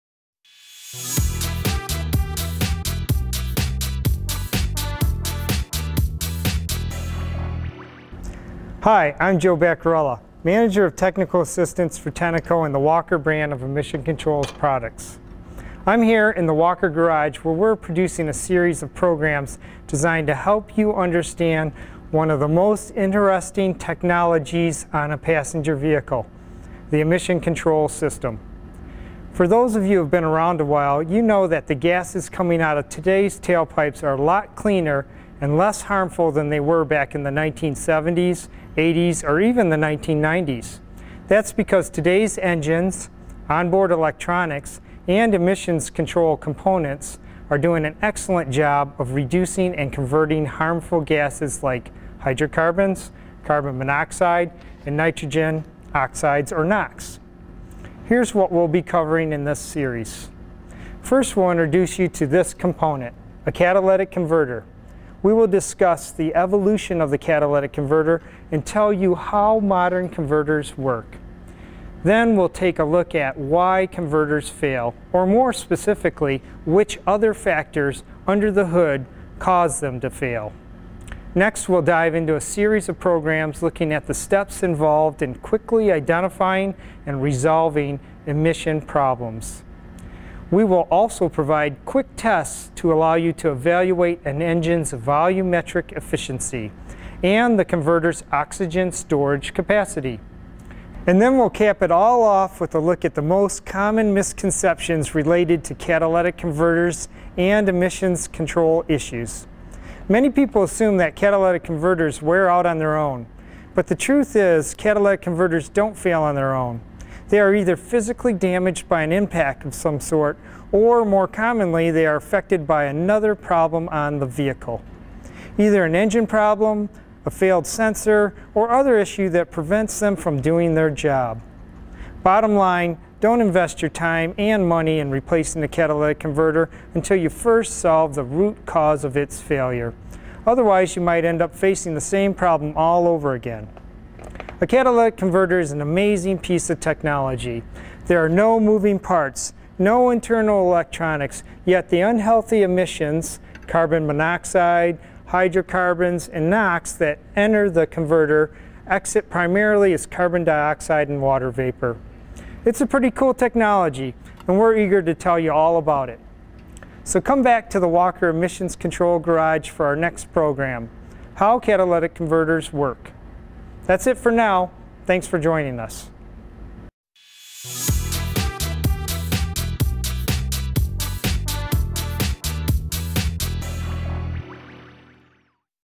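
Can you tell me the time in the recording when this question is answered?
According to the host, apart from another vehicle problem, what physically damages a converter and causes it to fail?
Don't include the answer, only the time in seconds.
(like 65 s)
119 s.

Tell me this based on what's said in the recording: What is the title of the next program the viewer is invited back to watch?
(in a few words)
How Catalytic Converters Work.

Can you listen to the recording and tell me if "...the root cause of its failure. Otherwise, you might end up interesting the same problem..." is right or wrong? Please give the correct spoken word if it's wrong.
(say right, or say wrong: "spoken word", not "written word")
wrong: "facing", not "interesting".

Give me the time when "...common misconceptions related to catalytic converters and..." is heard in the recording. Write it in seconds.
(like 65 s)
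103 s.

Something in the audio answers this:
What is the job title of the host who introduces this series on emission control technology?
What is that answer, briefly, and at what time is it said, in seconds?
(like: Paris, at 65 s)
Manager of Technical Assistance, at 10 s.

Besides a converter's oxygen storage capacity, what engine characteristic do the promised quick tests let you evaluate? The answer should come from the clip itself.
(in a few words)
volumetric efficiency.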